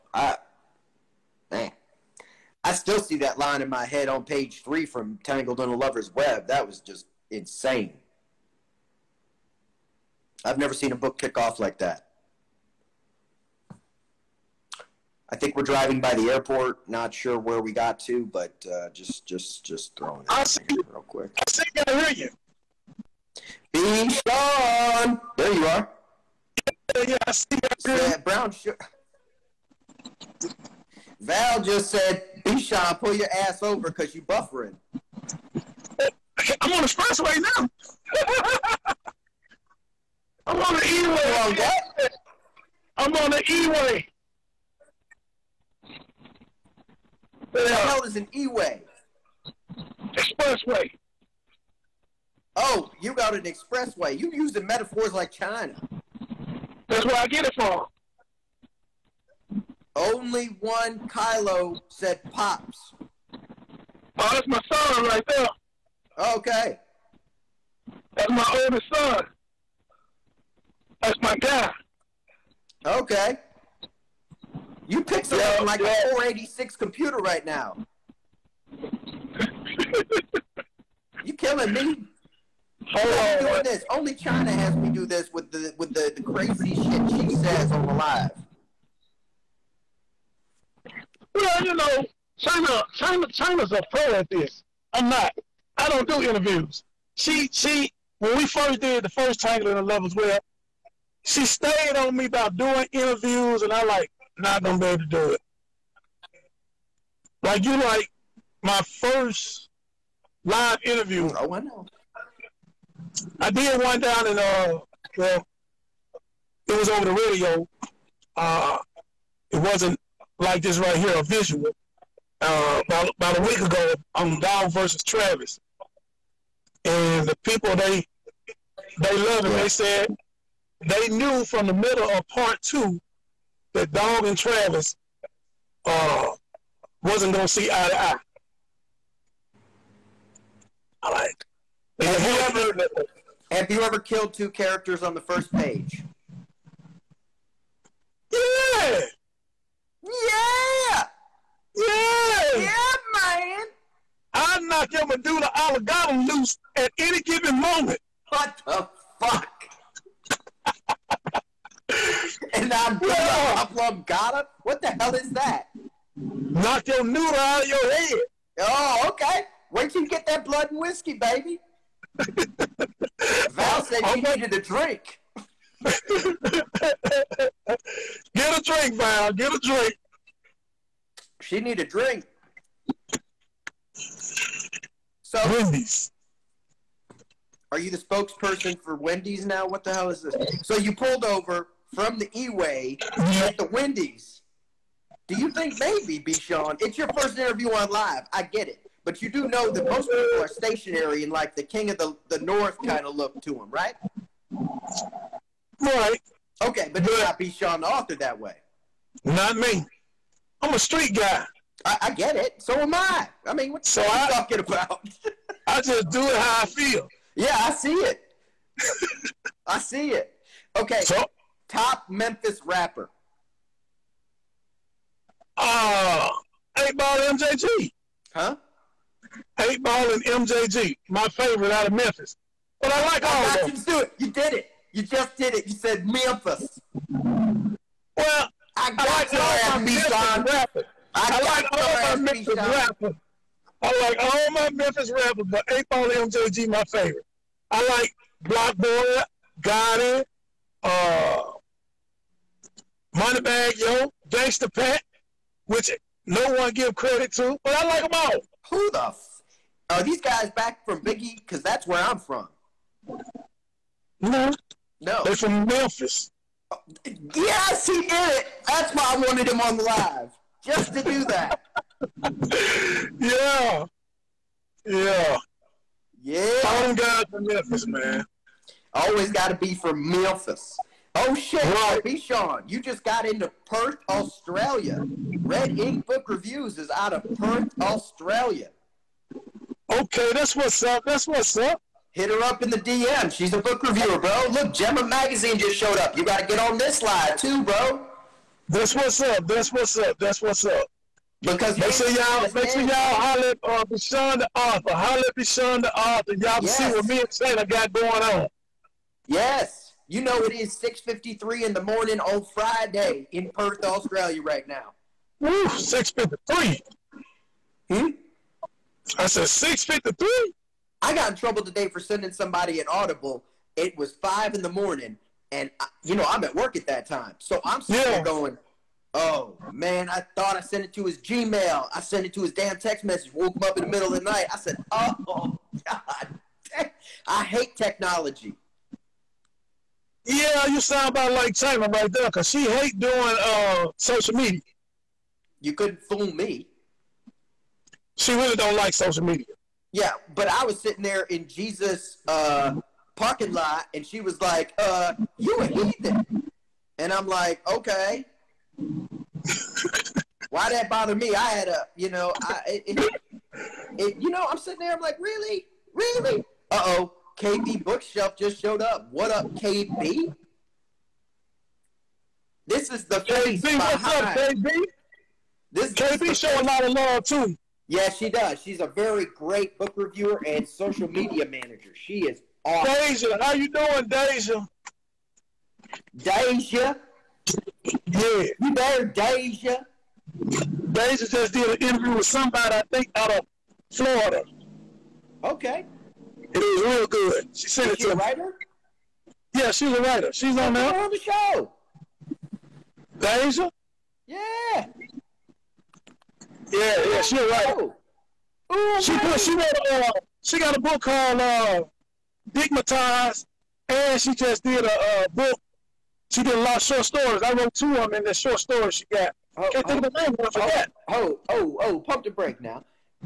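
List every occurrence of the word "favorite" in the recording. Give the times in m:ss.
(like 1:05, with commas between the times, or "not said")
3:51, 4:06.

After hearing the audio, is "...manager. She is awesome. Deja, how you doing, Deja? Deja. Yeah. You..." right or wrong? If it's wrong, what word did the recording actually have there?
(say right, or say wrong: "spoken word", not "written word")
right.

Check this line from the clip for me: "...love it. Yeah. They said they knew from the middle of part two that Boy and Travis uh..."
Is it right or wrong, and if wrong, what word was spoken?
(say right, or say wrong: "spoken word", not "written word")
wrong: "Dog", not "Boy".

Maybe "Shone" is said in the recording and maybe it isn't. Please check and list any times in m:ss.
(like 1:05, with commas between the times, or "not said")
0:24, 0:32, 3:16, 3:27, 5:05.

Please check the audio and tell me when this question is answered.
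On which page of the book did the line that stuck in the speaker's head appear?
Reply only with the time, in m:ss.
0:04.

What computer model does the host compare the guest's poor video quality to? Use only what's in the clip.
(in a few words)
486 computer.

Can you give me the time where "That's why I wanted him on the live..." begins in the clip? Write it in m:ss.
4:28.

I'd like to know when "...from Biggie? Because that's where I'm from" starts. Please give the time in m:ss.
4:20.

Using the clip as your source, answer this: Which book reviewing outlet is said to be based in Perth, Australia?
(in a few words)
Red Ink Book Reviews.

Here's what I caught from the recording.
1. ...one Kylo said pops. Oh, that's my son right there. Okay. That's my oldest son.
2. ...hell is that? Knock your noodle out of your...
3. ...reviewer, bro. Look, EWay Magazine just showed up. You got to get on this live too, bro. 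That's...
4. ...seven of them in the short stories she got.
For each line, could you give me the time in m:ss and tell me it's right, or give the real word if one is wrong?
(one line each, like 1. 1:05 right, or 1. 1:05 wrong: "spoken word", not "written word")
1. 1:00 right
2. 2:44 right
3. 4:53 wrong: "Gemma", not "EWay"
4. 6:57 wrong: "two", not "seven".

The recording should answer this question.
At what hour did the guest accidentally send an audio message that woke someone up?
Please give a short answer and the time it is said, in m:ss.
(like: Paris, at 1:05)
5 in the morning, at 5:24.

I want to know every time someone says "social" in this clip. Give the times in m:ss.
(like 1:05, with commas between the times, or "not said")
5:43, 5:48, 6:20.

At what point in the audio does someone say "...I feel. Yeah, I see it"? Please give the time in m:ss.
3:36.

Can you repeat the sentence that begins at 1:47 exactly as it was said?
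Like you, like my first live interview.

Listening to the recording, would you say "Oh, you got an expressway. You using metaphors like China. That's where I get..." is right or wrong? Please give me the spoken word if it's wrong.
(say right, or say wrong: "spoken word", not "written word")
right.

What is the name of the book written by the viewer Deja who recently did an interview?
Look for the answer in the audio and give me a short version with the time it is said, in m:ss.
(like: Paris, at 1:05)
Digmatized, at 6:52.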